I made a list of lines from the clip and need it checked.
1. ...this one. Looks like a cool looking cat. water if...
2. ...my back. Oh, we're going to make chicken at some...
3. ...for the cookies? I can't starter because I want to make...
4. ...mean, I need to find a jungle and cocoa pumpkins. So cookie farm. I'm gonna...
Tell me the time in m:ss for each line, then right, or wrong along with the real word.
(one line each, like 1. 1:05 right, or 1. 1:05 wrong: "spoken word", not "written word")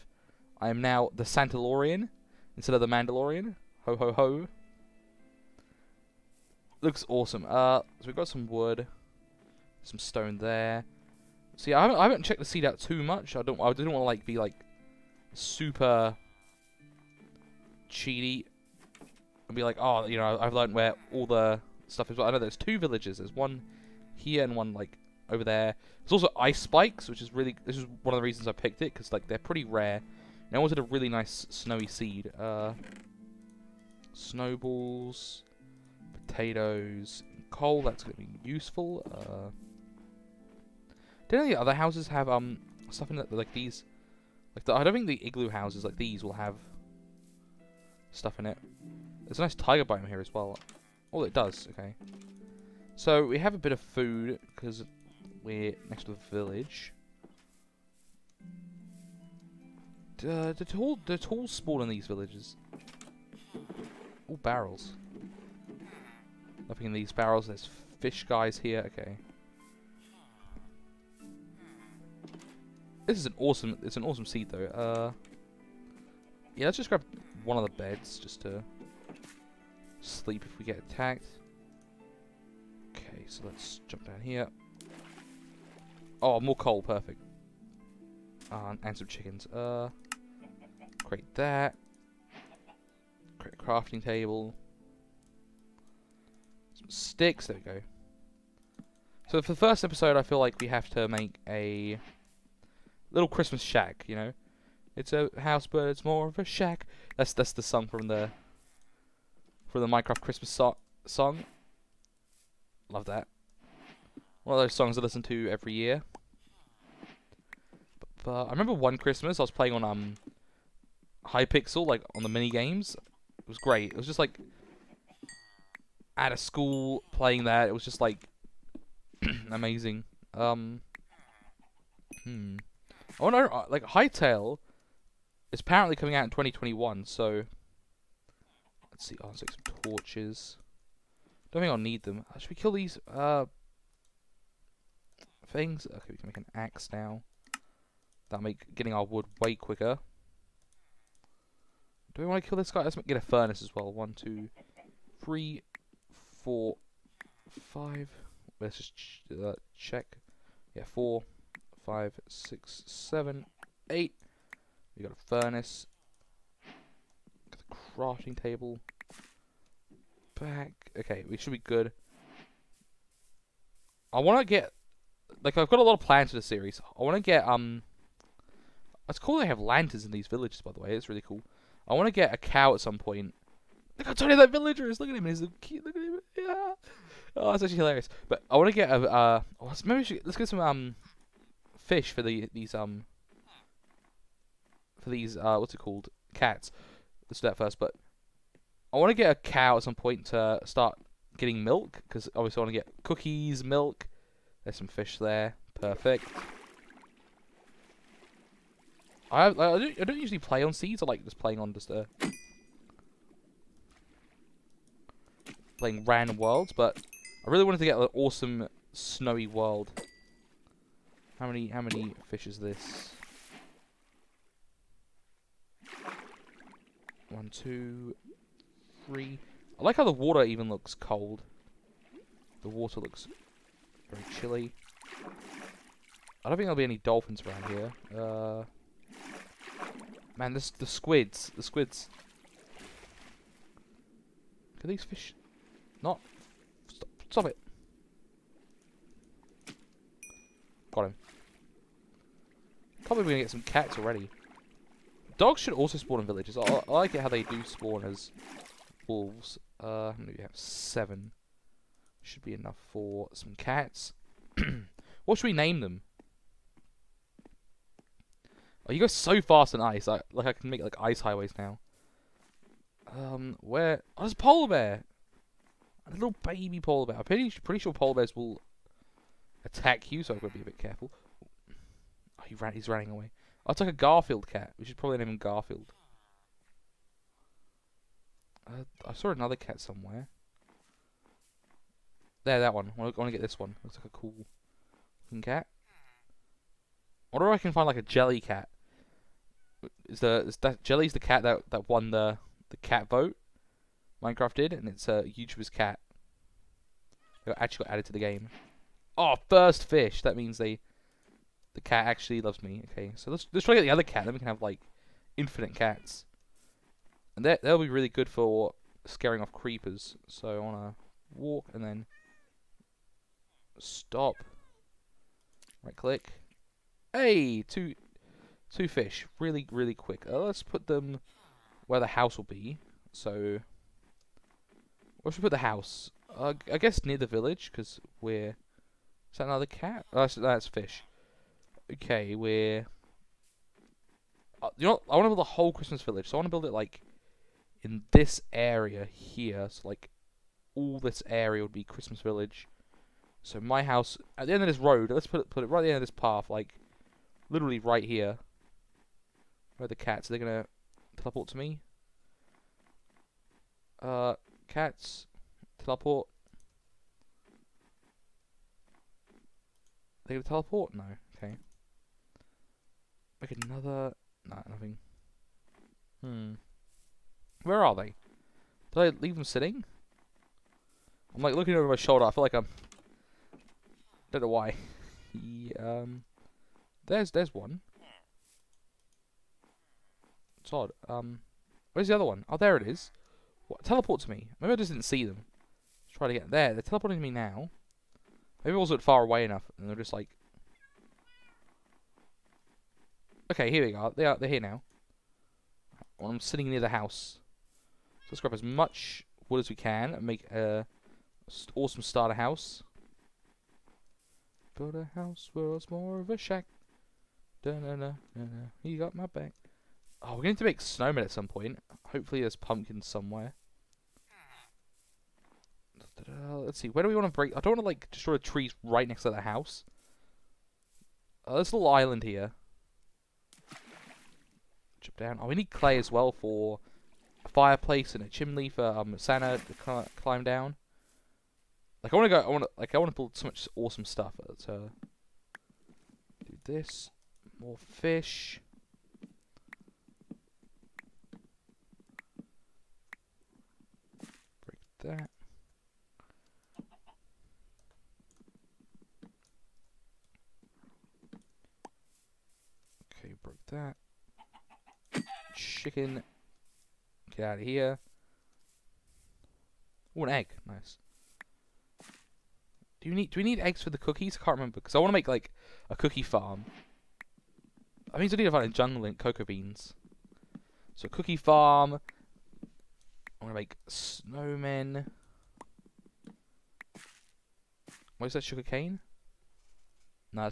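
1. 4:53 wrong: "wonder", not "water"
2. 6:59 wrong: "snowmen", not "chicken"
3. 7:53 wrong: "remember", not "starter"
4. 7:58 wrong: "beans", not "pumpkins".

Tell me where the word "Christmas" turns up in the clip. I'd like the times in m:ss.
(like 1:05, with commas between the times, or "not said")
1:43, 1:50, 1:58, 5:45, 5:51.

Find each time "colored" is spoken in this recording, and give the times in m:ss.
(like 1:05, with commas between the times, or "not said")
not said.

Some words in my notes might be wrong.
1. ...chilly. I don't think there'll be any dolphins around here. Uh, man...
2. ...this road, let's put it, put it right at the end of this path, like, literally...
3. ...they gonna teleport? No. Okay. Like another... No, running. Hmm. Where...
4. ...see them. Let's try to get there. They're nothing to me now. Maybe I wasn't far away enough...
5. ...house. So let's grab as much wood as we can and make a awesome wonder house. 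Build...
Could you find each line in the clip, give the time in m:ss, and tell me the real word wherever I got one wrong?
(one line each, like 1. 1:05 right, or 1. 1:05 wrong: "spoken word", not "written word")
1. 3:54 right
2. 5:54 right
3. 6:10 wrong: "nothing", not "running"
4. 6:35 wrong: "teleporting", not "nothing"
5. 6:46 wrong: "starter", not "wonder".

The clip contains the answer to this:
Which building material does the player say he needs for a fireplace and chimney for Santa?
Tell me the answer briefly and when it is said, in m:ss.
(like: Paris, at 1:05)
clay, at 7:15.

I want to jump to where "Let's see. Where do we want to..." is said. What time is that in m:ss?
7:06.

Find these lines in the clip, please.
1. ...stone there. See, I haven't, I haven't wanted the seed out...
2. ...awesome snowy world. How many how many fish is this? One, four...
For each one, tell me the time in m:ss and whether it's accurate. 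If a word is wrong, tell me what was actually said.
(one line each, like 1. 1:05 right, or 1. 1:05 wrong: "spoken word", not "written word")
1. 0:09 wrong: "checked", not "wanted"
2. 3:38 wrong: "two", not "four".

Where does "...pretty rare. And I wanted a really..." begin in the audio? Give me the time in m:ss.
0:29.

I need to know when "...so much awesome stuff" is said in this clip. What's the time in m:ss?
7:23.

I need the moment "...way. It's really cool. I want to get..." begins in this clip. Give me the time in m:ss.
3:00.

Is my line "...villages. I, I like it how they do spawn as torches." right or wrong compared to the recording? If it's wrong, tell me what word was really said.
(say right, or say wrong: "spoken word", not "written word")
wrong: "wolves", not "torches".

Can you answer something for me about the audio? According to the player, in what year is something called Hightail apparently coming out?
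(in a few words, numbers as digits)
2021.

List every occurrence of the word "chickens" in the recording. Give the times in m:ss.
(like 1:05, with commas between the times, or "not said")
1:29, 7:45.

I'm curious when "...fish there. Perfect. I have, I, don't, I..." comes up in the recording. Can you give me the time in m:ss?
3:24.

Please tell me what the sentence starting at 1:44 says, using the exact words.
It's a house, but it's more of a shack.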